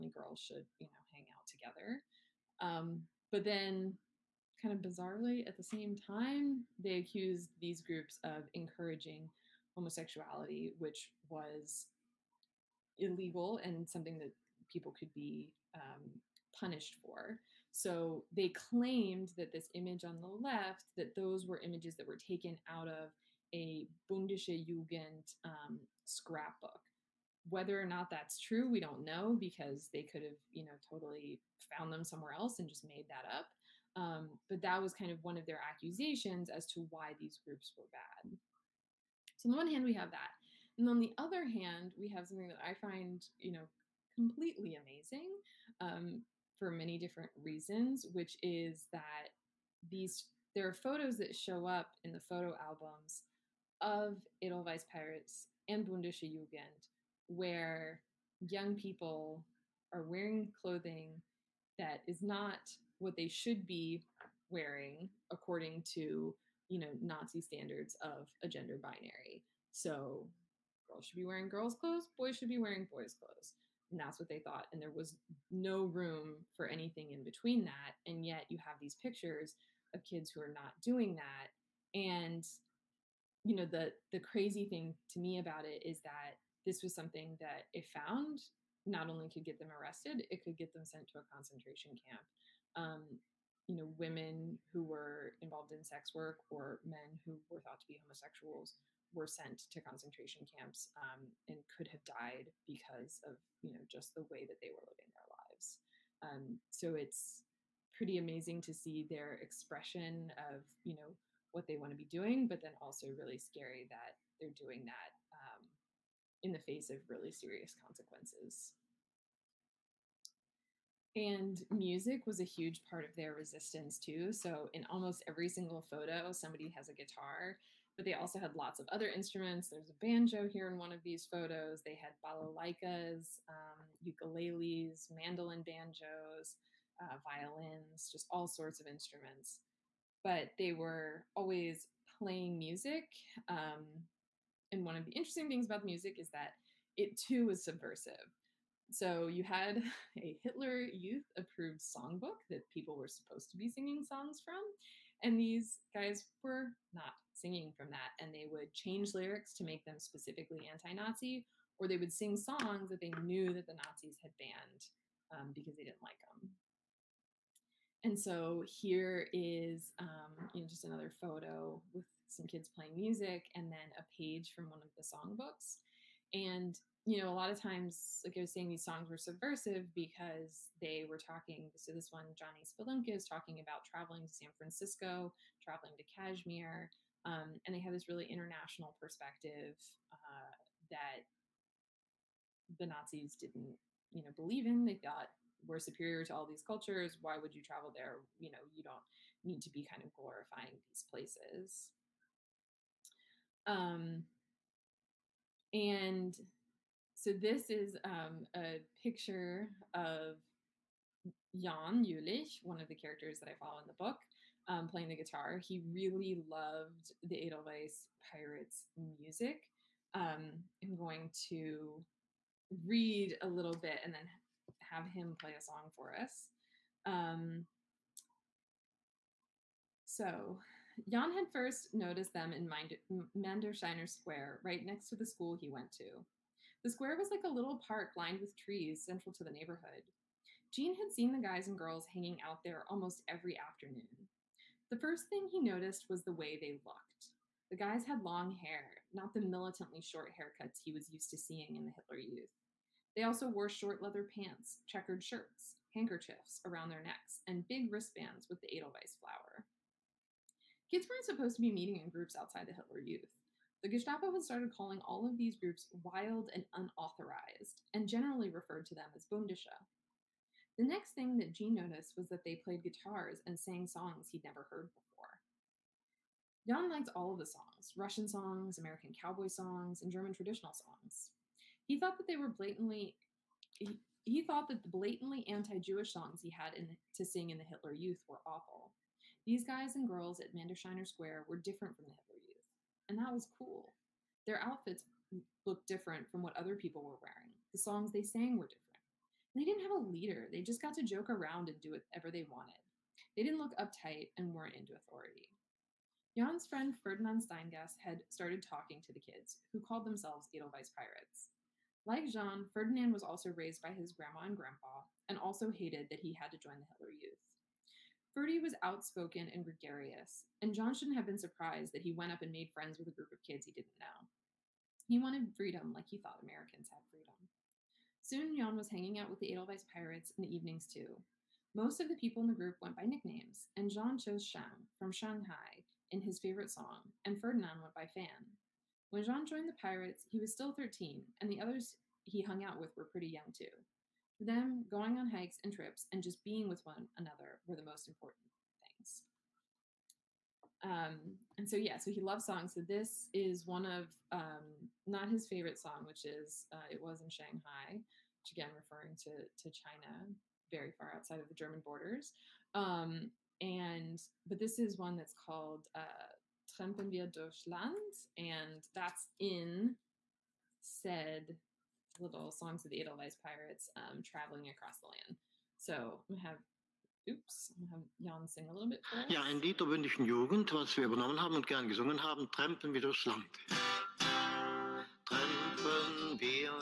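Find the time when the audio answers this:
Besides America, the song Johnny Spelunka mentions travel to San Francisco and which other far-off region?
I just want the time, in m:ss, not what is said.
3:06.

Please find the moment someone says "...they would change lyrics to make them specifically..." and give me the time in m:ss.
2:38.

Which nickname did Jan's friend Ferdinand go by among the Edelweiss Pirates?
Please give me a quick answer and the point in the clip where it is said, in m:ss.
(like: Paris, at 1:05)
Fan, at 5:38.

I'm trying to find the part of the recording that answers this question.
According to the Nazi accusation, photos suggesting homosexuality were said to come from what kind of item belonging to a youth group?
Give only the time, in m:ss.
0:26.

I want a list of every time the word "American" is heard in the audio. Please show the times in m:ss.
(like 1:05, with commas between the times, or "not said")
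4:38, 5:26.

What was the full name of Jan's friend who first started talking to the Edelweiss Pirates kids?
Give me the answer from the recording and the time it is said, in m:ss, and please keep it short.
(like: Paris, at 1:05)
Ferdinand Steingast, at 5:06.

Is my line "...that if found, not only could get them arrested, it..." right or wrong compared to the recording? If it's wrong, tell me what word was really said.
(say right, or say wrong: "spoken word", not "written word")
right.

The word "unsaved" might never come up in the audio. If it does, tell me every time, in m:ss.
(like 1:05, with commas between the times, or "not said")
not said.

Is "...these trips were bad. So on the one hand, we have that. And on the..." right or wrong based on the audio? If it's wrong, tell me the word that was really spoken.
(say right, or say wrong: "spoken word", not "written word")
wrong: "groups", not "trips".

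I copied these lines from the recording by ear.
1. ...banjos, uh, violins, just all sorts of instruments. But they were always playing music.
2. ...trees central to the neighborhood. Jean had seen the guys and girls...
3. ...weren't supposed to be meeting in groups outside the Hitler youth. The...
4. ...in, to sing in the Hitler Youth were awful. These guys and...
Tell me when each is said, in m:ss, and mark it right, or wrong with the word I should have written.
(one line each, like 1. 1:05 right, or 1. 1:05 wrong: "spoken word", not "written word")
1. 2:15 right
2. 3:58 right
3. 4:21 right
4. 4:46 right.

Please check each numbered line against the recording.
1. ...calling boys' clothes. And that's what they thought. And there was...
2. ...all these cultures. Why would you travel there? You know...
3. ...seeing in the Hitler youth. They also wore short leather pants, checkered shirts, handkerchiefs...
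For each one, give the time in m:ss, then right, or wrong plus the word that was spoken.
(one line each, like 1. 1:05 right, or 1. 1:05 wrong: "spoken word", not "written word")
1. 1:12 wrong: "wearing", not "calling"
2. 3:16 right
3. 4:11 right.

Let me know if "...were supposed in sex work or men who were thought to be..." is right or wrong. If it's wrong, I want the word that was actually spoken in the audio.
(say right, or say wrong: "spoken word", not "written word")
wrong: "involved", not "supposed".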